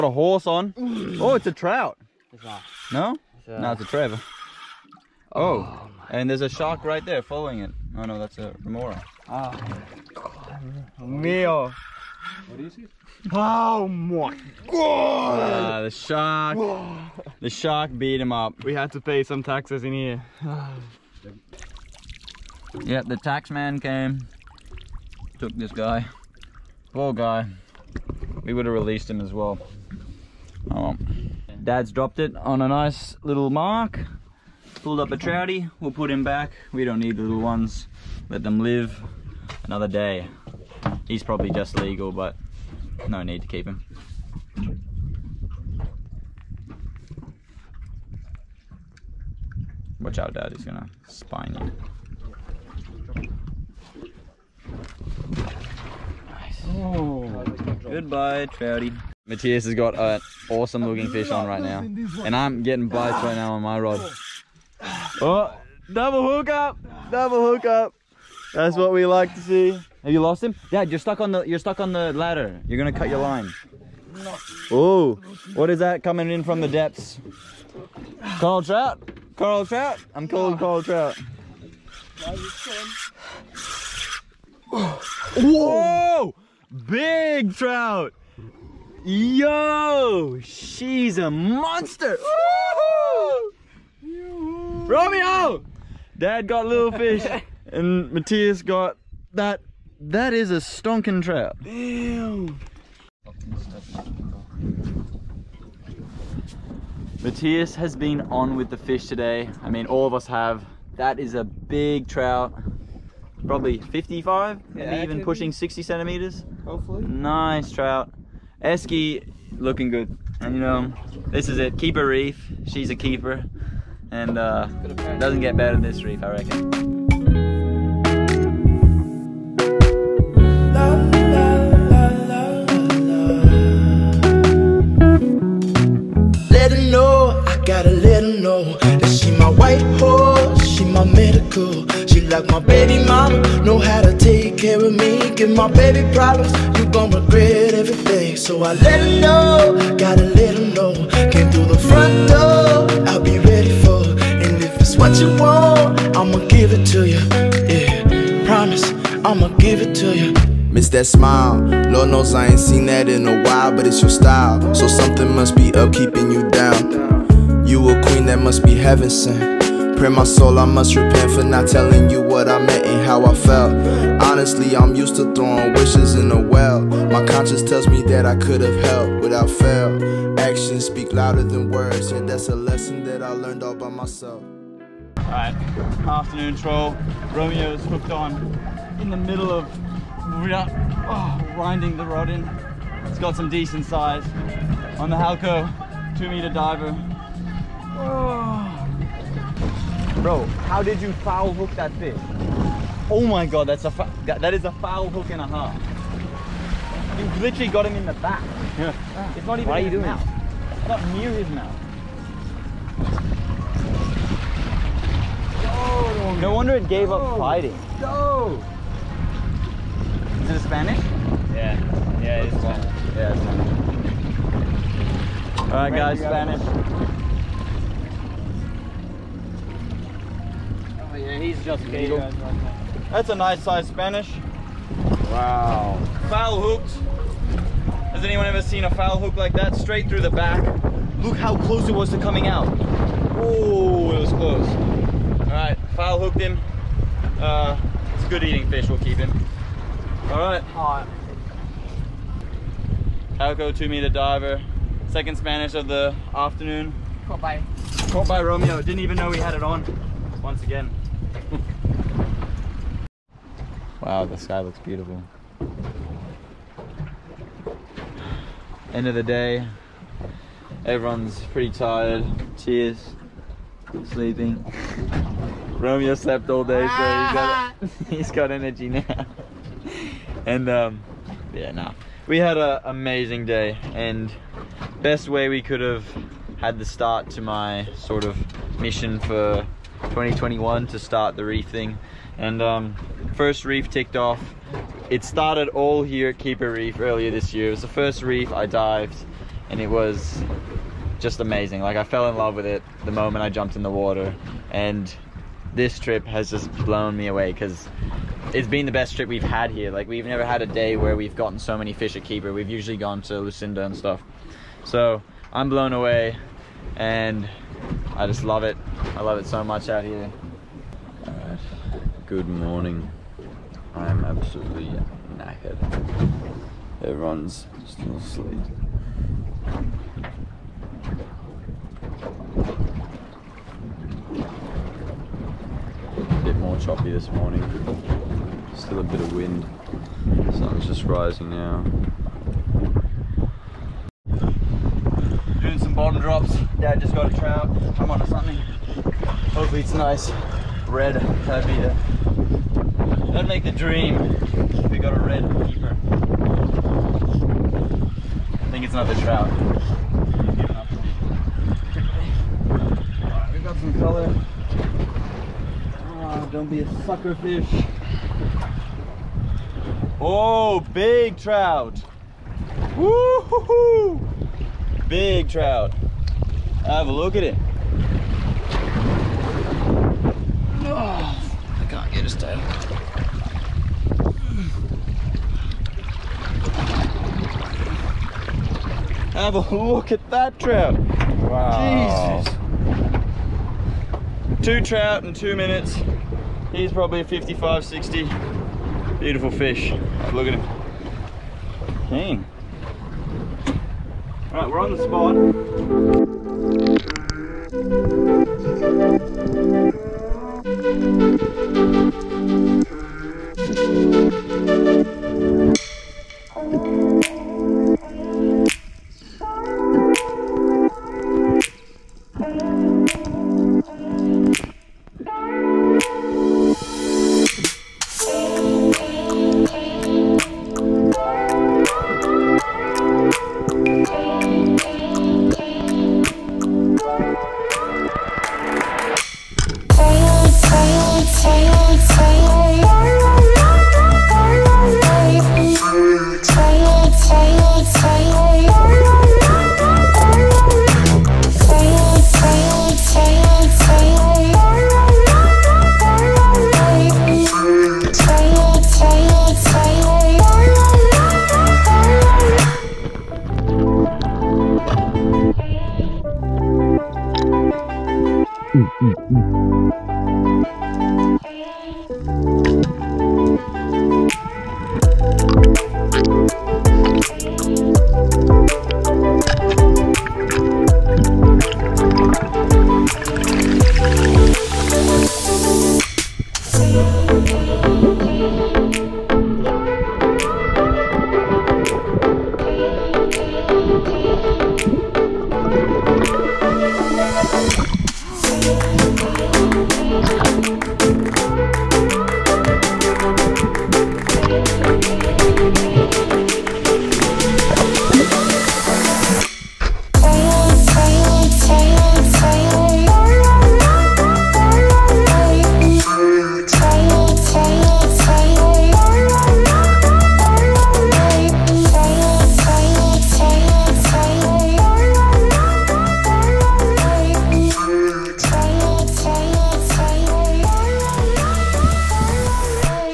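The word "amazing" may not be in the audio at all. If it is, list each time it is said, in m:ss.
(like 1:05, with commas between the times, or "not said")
4:42, 5:01.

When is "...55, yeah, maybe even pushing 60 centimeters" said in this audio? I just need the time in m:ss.
1:53.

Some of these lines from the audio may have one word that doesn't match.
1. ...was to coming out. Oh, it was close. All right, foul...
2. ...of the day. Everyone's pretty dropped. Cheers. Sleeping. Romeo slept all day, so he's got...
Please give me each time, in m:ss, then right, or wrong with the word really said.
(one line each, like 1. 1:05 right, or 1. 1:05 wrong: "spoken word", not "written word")
1. 4:01 right
2. 4:29 wrong: "tired", not "dropped".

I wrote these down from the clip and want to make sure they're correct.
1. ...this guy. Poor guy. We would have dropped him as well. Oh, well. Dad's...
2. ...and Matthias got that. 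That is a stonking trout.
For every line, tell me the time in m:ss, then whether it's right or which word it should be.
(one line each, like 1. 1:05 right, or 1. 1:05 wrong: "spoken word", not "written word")
1. 0:25 wrong: "released", not "dropped"
2. 1:37 right.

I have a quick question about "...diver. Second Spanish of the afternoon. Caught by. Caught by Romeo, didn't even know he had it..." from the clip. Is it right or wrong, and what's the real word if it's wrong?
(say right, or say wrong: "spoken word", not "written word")
right.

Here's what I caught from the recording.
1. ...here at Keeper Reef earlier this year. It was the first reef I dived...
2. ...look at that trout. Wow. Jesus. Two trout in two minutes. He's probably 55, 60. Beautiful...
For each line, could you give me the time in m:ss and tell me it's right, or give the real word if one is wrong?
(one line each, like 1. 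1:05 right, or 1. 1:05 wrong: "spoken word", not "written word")
1. 4:56 right
2. 6:29 right.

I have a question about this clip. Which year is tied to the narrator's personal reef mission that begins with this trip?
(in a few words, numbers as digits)
2021.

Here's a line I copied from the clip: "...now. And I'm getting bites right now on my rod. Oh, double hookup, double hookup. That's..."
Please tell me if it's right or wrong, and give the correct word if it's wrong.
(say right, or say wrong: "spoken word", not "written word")
right.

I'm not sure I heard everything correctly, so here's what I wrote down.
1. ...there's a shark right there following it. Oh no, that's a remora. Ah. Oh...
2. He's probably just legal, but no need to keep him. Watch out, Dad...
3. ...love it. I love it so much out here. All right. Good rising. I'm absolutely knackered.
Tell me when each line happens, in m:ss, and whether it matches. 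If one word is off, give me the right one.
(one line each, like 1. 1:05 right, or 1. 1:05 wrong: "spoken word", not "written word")
1. 0:06 right
2. 0:41 right
3. 5:18 wrong: "morning", not "rising".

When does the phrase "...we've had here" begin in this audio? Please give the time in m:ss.
5:09.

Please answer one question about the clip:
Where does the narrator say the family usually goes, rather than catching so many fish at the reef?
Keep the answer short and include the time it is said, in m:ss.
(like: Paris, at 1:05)
Lucinda, at 5:13.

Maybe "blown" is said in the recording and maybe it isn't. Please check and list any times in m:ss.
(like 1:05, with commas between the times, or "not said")
5:06, 5:15.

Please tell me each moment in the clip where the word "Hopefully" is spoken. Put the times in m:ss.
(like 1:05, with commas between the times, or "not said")
1:56, 5:48.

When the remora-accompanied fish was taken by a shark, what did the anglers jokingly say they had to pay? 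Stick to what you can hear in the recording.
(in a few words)
taxes.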